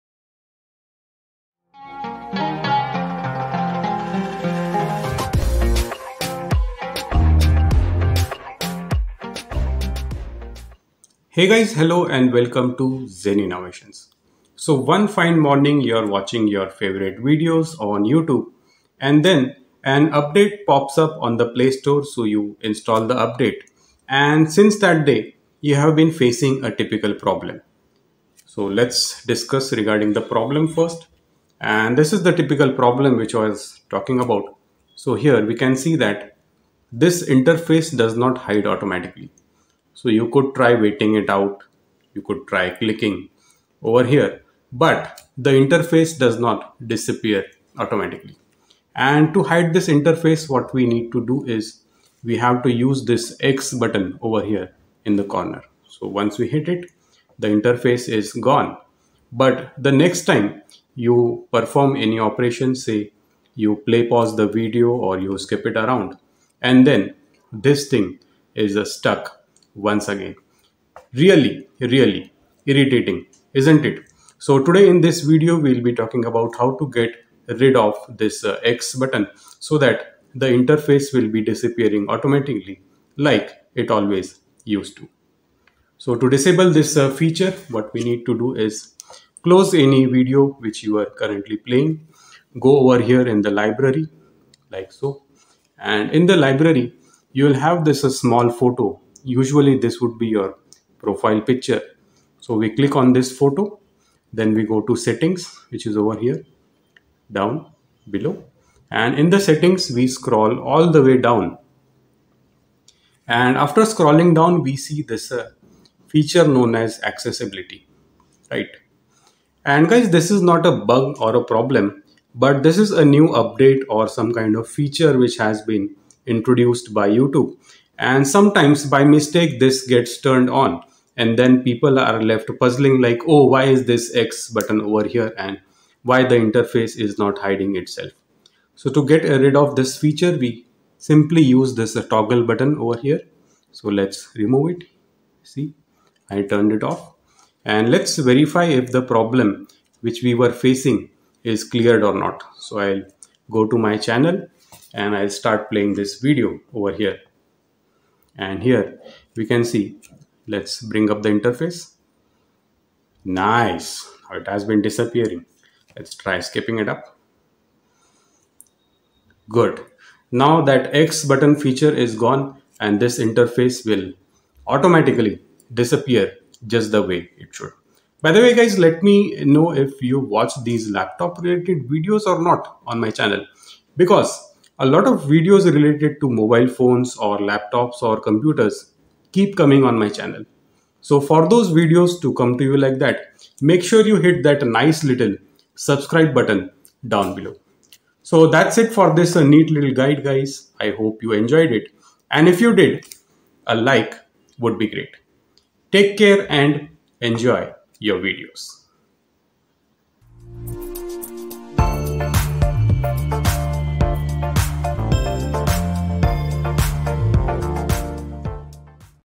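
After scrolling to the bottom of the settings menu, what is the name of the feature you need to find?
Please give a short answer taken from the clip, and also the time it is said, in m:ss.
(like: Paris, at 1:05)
Accessibility, at 1:57.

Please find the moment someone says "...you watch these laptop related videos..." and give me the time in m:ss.
3:00.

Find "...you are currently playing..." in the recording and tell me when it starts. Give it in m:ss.
1:30.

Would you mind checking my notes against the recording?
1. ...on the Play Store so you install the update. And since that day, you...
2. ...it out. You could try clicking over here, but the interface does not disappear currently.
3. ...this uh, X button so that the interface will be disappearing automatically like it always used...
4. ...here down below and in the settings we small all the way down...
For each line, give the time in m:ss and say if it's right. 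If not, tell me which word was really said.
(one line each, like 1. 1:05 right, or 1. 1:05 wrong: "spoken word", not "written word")
1. 0:21 right
2. 0:41 wrong: "automatically", not "currently"
3. 1:18 right
4. 1:46 wrong: "scroll", not "small".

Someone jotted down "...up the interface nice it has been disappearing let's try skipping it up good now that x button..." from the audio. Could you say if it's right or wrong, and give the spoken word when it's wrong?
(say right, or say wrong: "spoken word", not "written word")
right.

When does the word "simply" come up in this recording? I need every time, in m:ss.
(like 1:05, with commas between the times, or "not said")
2:21.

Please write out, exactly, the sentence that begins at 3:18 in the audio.
So that's it for this neat little guide guys.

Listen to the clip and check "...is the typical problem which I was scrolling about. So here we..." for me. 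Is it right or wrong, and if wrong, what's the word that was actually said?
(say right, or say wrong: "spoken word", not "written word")
wrong: "talking", not "scrolling".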